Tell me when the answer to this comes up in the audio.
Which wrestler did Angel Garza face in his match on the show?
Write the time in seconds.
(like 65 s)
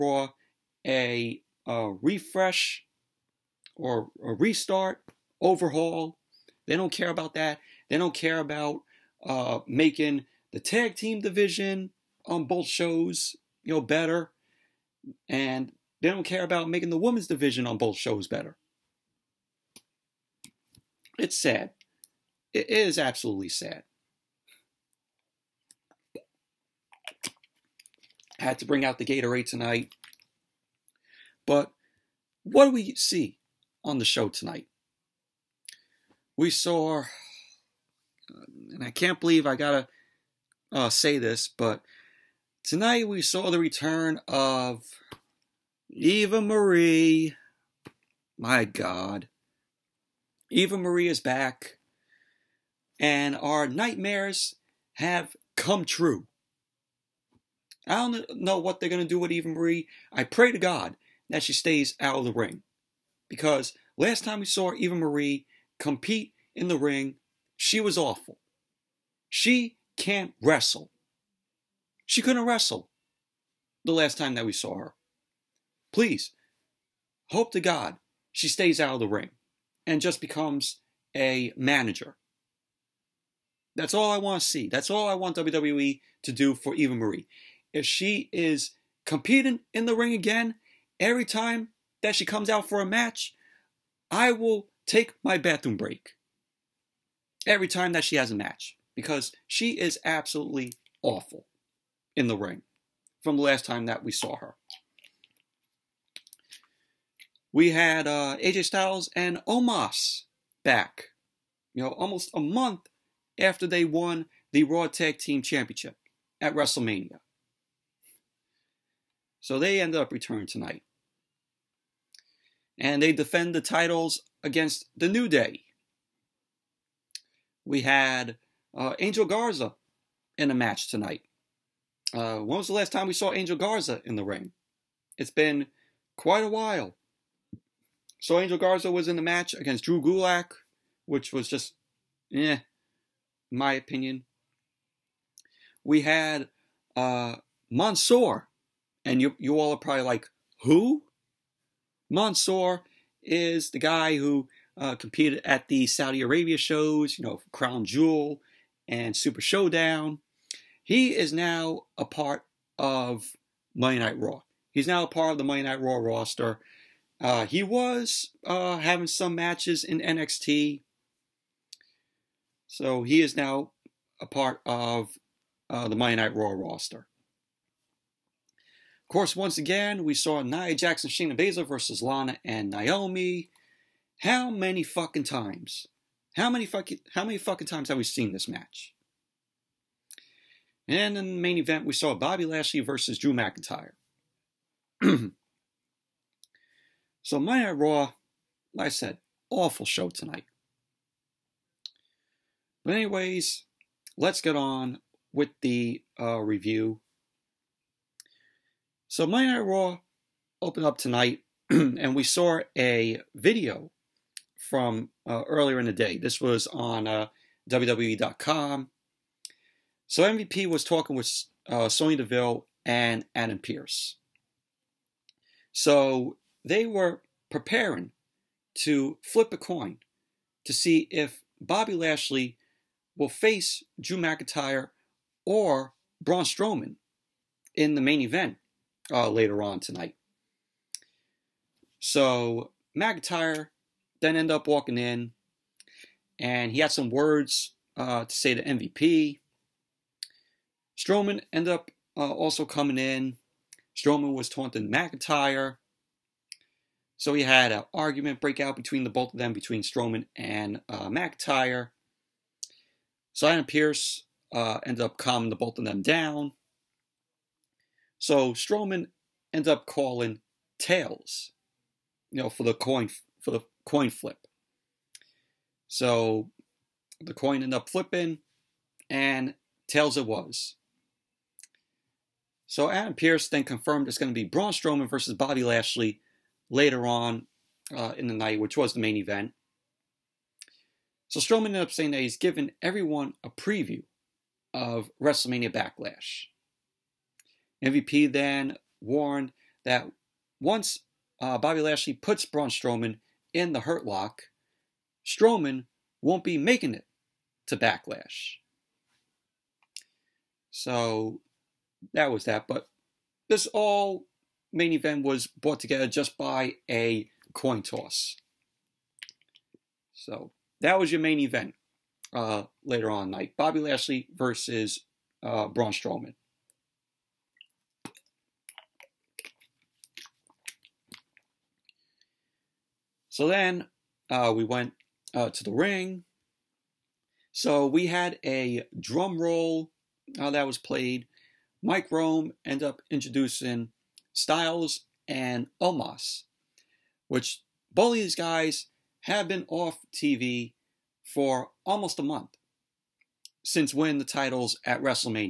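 139 s.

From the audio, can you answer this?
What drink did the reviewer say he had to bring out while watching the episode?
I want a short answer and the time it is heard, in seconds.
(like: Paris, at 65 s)
Gatorade, at 29 s.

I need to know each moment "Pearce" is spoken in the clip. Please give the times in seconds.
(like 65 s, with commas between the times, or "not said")
263 s, 283 s.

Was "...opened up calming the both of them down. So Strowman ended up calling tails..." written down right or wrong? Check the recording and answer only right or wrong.
wrong.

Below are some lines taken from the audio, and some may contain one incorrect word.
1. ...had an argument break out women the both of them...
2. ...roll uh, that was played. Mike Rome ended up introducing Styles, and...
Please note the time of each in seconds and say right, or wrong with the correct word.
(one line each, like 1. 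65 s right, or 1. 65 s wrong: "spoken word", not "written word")
1. 257 s wrong: "between", not "women"
2. 339 s right.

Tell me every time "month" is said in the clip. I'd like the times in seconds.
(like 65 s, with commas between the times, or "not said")
112 s, 352 s.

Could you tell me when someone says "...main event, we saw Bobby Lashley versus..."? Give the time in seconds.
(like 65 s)
191 s.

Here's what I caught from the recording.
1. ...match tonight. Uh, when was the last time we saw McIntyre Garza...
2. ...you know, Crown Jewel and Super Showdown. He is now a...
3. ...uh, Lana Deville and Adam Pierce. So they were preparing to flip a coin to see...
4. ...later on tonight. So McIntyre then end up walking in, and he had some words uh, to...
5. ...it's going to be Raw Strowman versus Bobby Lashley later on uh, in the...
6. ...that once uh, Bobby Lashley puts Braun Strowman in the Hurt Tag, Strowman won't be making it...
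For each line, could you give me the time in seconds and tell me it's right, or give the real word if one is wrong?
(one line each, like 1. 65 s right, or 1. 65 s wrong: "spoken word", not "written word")
1. 130 s wrong: "Angel", not "McIntyre"
2. 157 s right
3. 221 s wrong: "Sonya", not "Lana"
4. 239 s right
5. 284 s wrong: "Braun", not "Raw"
6. 299 s wrong: "Lock", not "Tag".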